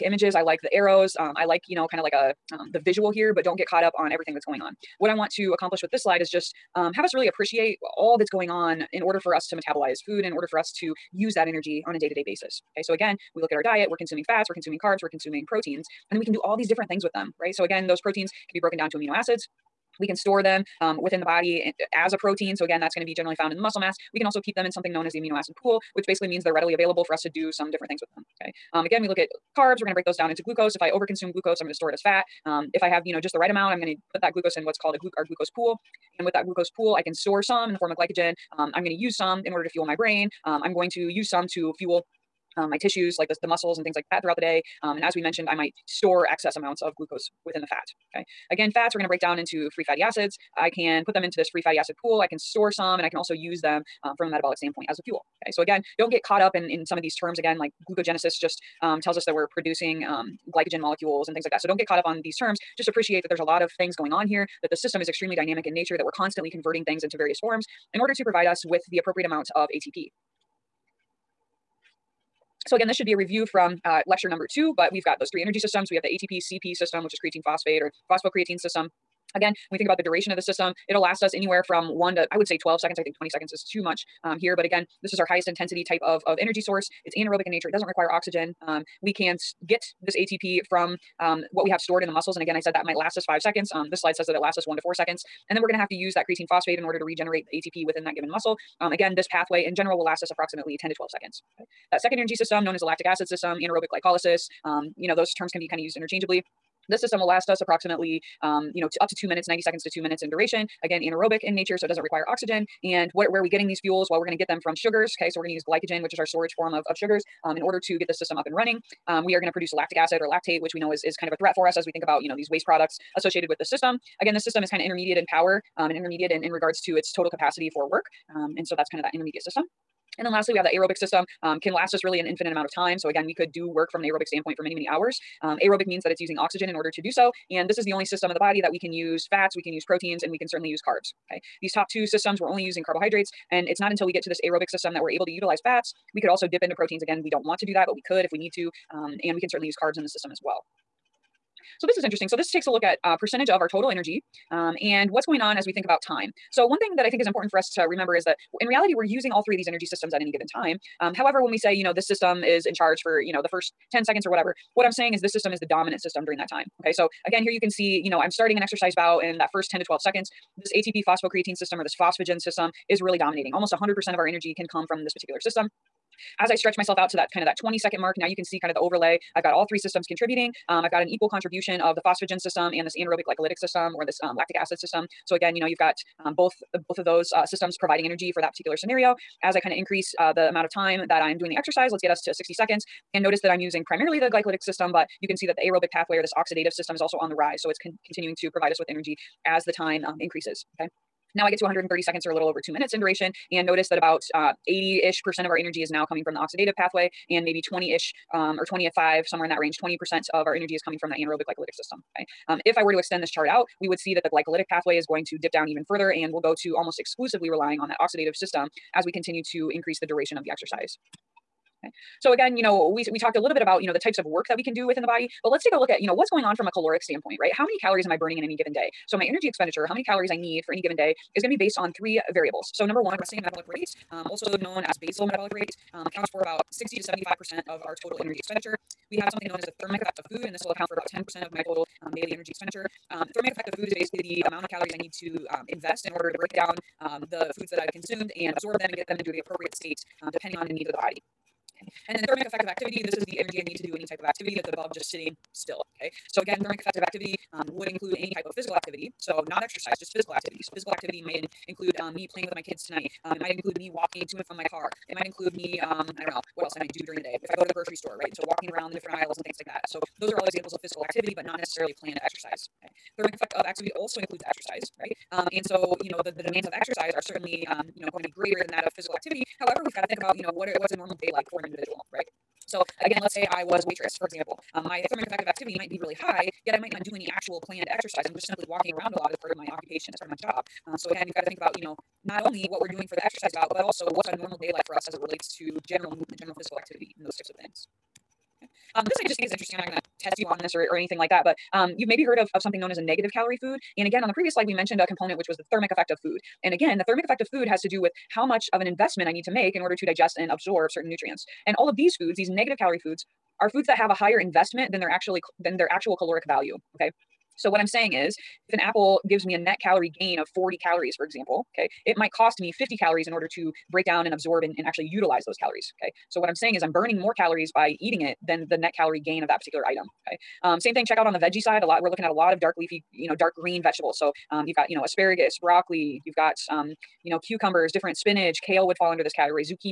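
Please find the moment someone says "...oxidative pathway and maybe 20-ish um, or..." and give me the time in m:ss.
3:26.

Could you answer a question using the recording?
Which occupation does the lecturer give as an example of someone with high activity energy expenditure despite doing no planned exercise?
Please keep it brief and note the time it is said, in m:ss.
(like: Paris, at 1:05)
waitress, at 4:43.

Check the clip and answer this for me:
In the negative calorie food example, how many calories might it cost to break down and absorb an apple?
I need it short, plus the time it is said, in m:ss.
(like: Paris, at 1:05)
50 calories, at 5:22.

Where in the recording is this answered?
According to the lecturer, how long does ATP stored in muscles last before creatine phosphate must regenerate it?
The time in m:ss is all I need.
1:34.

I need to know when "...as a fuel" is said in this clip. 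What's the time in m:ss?
0:54.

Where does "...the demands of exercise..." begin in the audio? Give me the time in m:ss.
4:36.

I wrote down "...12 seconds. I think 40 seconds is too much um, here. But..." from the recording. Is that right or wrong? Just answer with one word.
wrong.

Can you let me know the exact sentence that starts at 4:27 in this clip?
If I go to the grocery store, right?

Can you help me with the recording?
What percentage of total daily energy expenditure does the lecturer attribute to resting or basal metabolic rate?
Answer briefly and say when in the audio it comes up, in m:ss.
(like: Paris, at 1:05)
60 to 75%, at 3:56.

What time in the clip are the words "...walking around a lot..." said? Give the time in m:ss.
4:48.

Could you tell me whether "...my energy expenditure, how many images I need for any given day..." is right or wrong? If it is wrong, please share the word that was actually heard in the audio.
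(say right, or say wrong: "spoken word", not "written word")
wrong: "calories", not "images".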